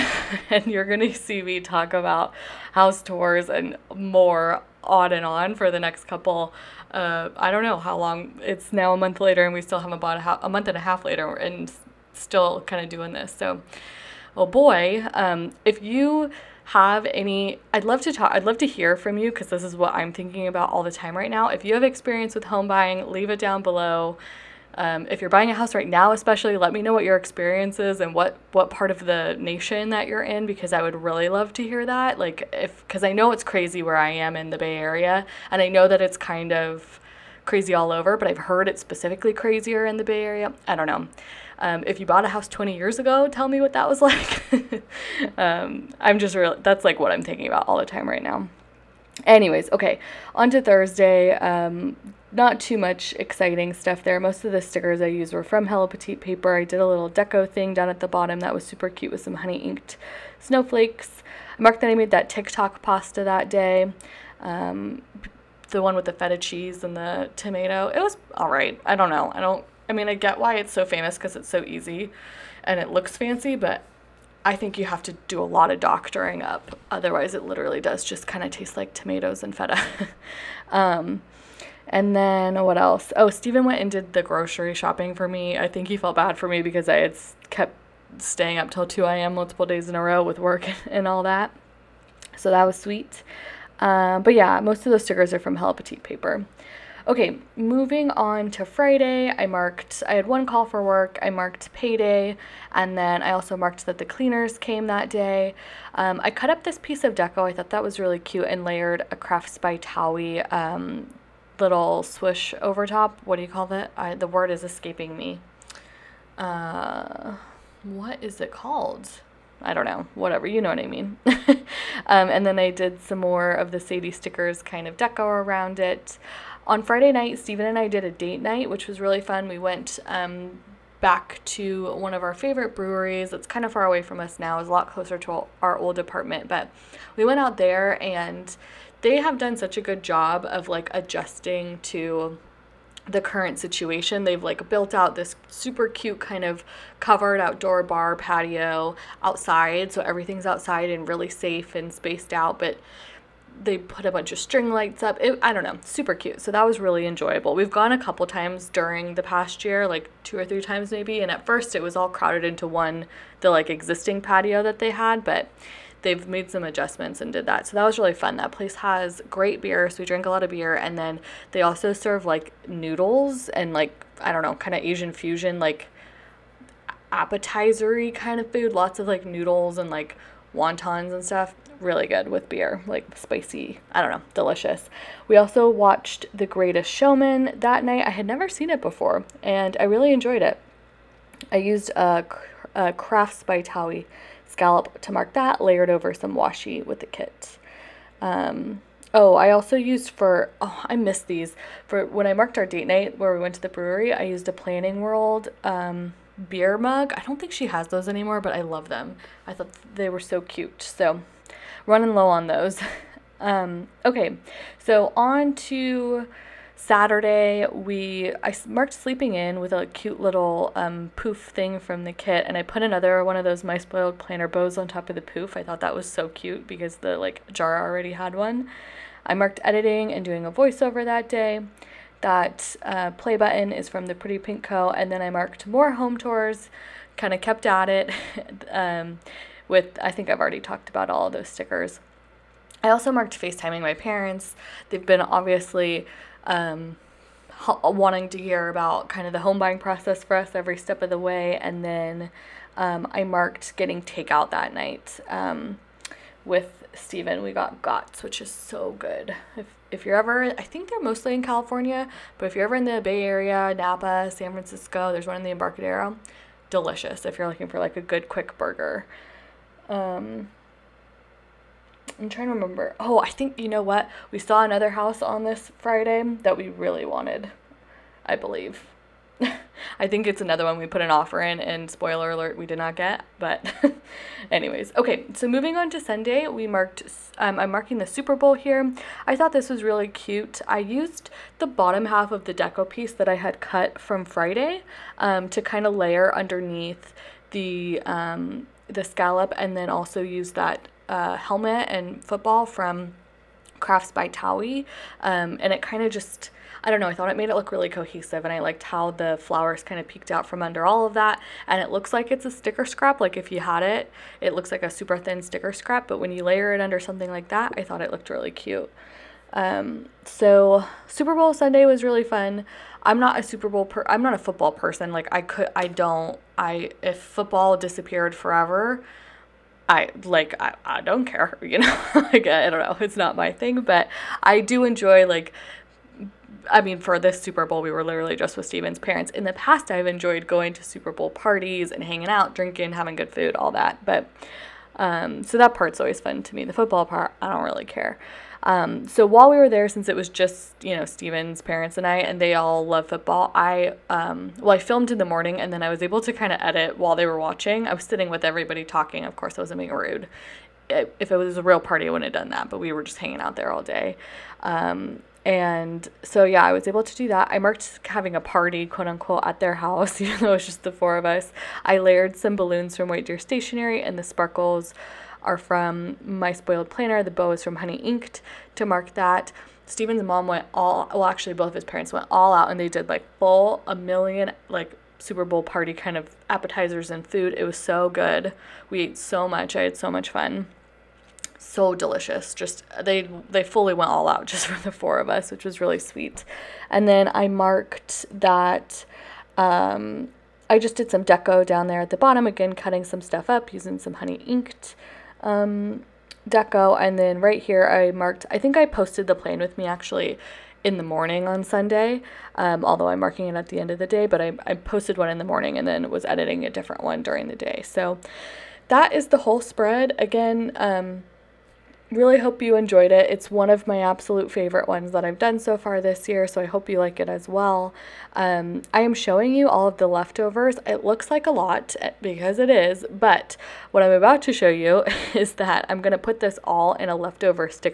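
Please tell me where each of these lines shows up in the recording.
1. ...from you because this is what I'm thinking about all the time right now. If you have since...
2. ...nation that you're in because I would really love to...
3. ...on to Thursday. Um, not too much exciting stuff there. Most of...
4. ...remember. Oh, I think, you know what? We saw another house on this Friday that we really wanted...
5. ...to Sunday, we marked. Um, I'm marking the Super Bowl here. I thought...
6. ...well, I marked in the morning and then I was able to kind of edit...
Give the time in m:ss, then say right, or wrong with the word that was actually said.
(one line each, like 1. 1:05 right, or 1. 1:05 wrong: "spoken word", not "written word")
1. 0:18 wrong: "experience", not "since"
2. 0:29 right
3. 0:50 right
4. 4:32 right
5. 4:45 right
6. 5:54 wrong: "filmed", not "marked".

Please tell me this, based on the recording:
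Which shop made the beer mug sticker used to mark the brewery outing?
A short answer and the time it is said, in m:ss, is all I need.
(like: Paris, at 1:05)
Planning World, at 3:24.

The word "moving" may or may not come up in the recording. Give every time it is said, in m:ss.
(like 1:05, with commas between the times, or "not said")
1:37, 4:45.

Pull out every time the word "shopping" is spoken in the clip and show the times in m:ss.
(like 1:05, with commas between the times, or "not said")
1:24.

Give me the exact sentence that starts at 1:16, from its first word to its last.
Otherwise, it literally does just kind of taste like tomatoes and feta.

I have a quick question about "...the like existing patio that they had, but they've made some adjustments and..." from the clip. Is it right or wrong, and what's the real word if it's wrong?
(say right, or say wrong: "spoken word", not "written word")
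right.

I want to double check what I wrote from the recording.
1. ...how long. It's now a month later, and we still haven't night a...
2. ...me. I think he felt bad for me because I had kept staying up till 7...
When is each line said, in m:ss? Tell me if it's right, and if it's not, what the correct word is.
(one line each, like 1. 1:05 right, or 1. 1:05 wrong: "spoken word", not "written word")
1. 0:07 wrong: "bought", not "night"
2. 1:25 wrong: "2", not "7".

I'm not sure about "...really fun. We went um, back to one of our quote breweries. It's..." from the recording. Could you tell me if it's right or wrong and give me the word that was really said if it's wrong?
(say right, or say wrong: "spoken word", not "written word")
wrong: "favorite", not "quote".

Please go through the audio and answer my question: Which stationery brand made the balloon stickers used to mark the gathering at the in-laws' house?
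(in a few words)
White Deer Stationery.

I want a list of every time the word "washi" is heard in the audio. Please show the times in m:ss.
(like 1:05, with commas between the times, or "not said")
3:16.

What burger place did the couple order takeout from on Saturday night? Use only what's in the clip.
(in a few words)
Gott's.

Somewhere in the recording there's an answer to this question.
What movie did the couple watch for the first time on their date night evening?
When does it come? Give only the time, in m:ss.
3:06.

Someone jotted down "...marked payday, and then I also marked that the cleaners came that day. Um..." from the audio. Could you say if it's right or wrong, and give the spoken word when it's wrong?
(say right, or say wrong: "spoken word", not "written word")
right.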